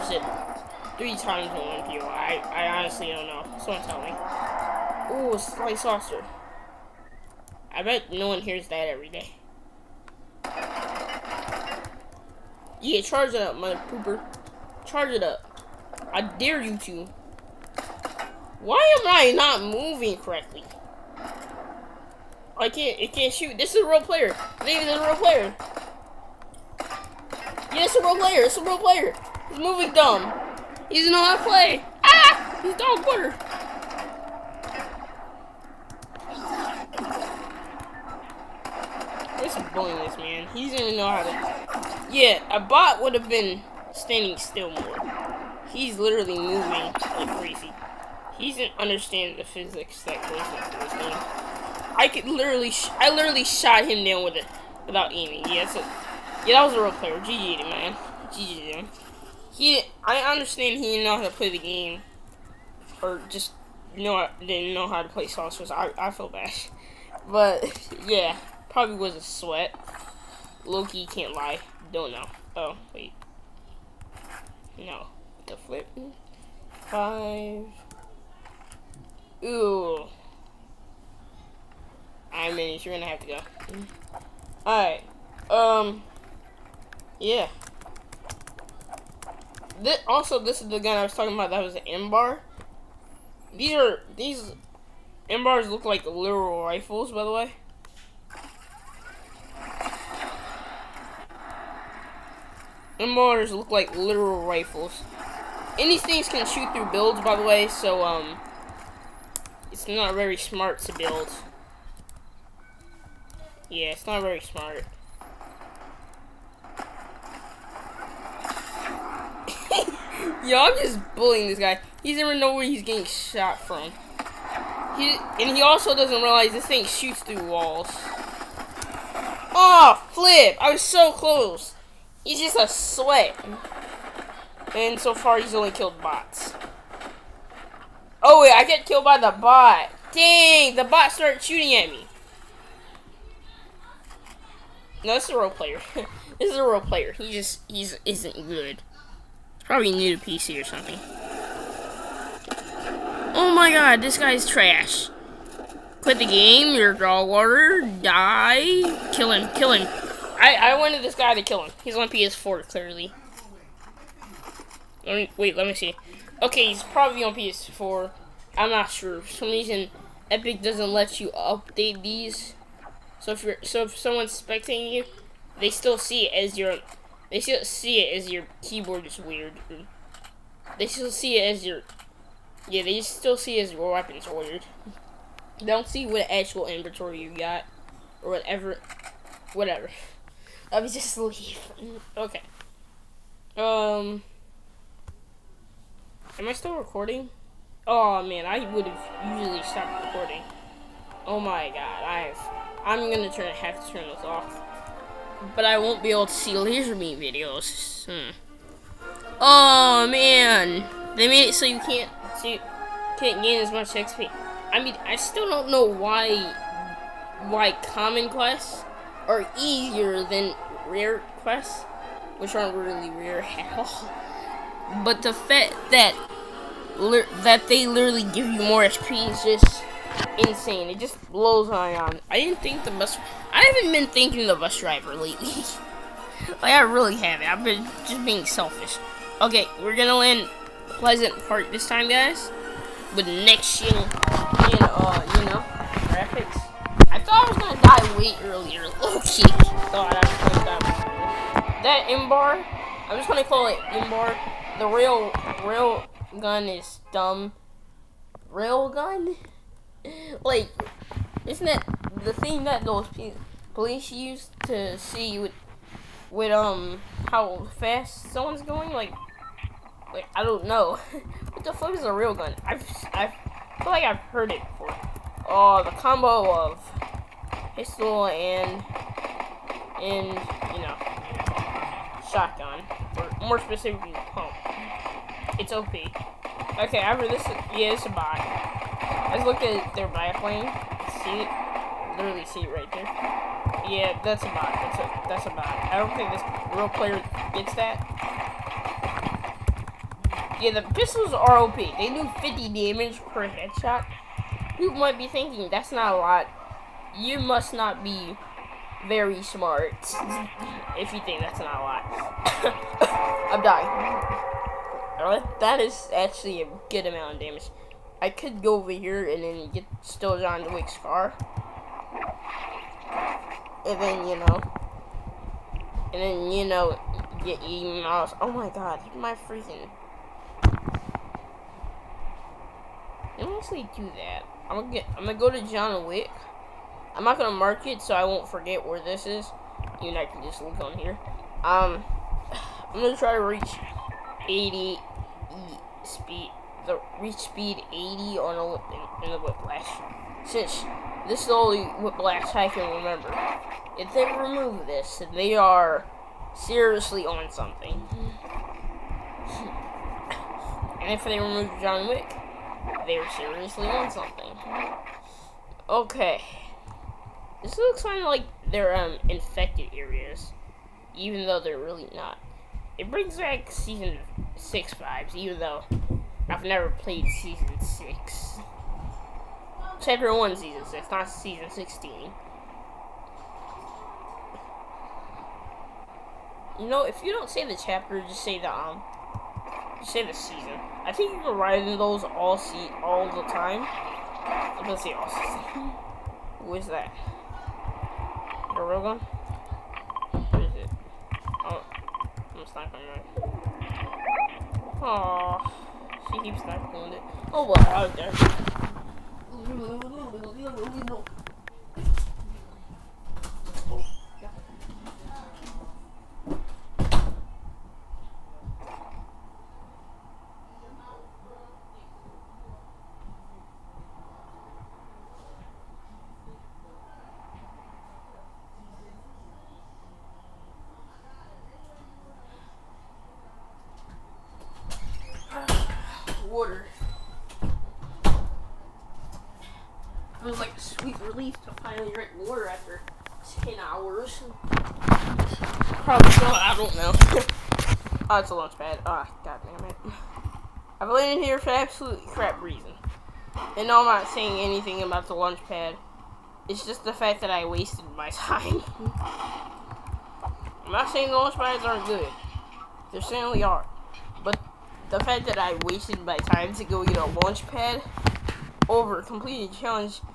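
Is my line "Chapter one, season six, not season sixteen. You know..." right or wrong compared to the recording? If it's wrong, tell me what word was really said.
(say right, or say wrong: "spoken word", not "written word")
right.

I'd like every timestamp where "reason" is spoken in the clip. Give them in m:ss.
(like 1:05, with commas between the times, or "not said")
2:49, 7:32.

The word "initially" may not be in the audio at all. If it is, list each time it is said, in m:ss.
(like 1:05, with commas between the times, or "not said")
not said.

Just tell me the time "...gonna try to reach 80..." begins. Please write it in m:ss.
5:43.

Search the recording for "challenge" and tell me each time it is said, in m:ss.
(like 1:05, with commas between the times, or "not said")
7:49.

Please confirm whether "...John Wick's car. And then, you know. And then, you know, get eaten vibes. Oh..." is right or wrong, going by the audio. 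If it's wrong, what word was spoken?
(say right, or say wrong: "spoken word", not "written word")
wrong: "miles", not "vibes".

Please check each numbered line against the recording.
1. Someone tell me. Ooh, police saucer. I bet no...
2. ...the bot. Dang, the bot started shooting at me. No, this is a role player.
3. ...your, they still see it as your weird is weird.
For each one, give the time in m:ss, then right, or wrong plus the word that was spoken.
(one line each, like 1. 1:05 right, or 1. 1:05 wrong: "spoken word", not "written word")
1. 0:03 wrong: "slice", not "police"
2. 2:19 right
3. 2:56 wrong: "keyboard", not "weird".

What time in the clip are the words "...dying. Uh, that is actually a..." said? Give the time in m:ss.
5:13.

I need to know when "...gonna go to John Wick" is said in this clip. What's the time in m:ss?
5:35.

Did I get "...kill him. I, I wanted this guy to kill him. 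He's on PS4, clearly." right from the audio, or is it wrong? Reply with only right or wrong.
right.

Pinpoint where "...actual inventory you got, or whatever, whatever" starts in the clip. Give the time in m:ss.
3:06.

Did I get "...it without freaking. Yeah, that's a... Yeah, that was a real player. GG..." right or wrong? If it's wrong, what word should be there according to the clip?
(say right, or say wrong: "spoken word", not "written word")
wrong: "aiming", not "freaking".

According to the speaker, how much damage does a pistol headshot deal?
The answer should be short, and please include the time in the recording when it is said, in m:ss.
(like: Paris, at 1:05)
50, at 5:02.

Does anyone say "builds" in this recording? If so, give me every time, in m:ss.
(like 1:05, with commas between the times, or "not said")
1:46, 1:50.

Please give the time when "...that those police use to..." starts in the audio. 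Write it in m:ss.
4:22.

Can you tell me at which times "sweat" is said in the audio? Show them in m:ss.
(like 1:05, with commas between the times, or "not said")
1:09, 2:12.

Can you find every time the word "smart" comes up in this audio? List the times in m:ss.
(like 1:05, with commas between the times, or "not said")
1:50, 1:54, 5:09.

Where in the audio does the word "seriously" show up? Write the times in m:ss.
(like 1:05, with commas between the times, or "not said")
5:56, 6:03.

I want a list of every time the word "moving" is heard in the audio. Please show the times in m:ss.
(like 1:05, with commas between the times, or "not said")
0:19, 0:29, 0:46.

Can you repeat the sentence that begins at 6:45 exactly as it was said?
Aw, she keeps sniping on it.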